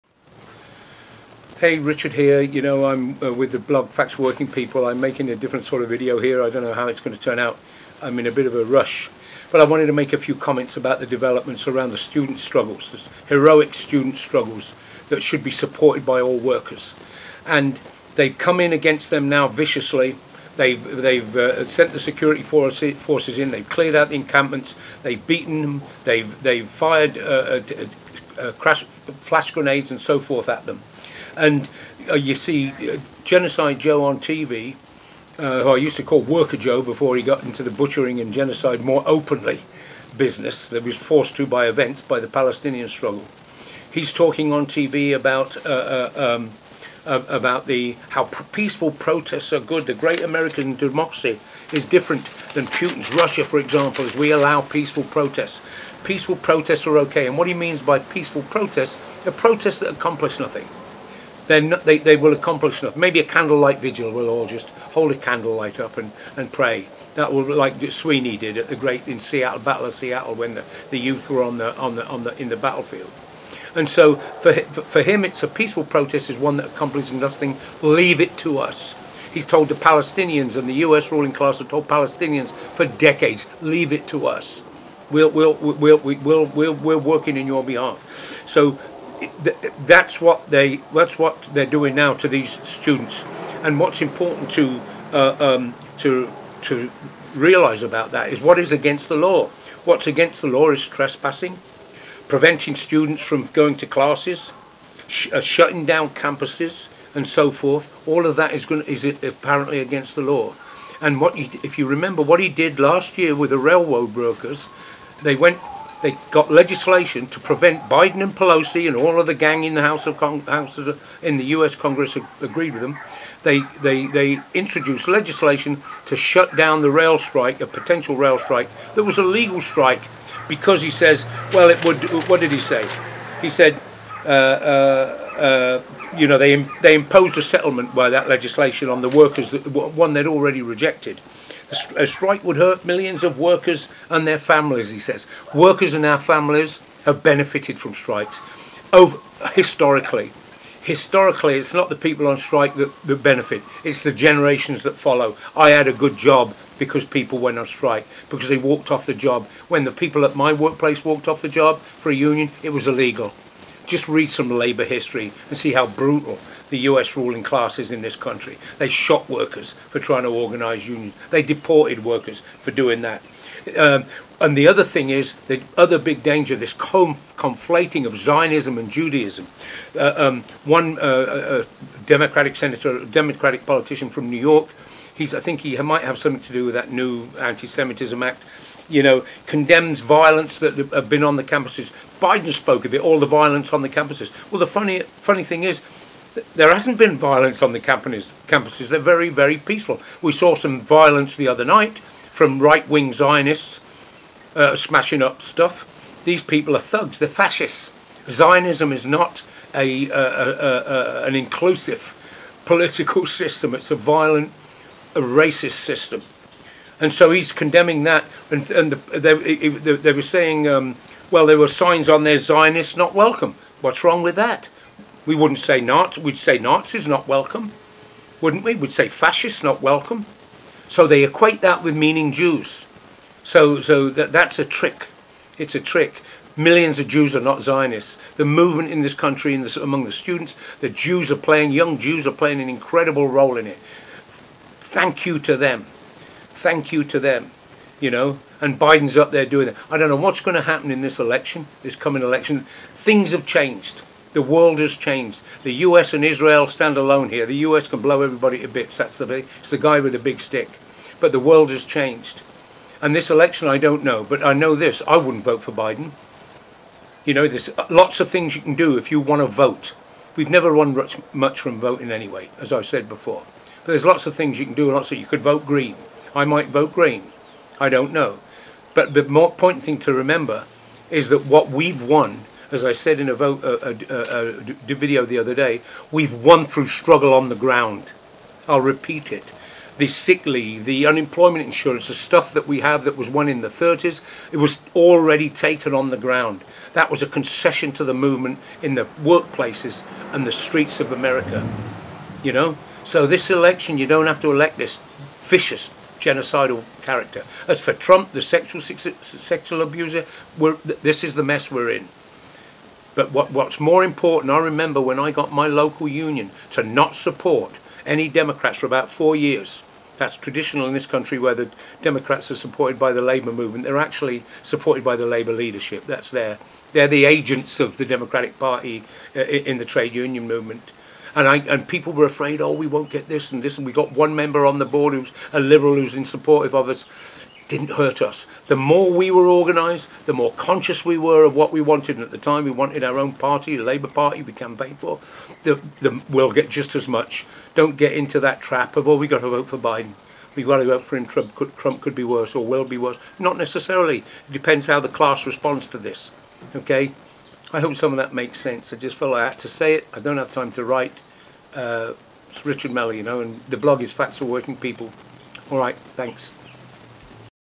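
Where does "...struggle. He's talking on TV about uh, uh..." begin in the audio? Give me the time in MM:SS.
00:42.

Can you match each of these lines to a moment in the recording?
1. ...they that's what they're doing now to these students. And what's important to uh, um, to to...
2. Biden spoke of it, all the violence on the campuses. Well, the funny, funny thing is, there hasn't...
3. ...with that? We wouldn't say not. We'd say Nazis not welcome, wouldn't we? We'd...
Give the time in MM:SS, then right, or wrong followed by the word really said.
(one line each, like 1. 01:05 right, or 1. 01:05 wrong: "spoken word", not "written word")
1. 01:30 right
2. 03:12 right
3. 03:44 right.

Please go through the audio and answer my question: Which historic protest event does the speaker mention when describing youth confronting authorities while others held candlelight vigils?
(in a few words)
Battle of Seattle.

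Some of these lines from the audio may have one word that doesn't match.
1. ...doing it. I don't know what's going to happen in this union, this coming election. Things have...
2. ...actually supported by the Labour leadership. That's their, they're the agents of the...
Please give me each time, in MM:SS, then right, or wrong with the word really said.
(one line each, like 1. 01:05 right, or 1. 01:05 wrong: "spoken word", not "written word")
1. 04:09 wrong: "election", not "union"
2. 05:23 right.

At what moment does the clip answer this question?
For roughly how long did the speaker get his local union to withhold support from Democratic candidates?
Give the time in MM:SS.
05:19.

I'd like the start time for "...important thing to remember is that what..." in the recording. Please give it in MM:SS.
04:39.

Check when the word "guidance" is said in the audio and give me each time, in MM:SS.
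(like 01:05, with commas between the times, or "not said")
not said.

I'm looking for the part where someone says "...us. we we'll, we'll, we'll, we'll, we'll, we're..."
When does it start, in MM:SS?
01:24.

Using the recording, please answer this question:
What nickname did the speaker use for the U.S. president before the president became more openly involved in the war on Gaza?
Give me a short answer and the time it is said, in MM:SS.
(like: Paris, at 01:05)
Worker Joe, at 00:36.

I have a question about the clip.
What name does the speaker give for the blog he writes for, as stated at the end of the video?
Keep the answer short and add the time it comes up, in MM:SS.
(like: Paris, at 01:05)
Facts for Working People, at 06:04.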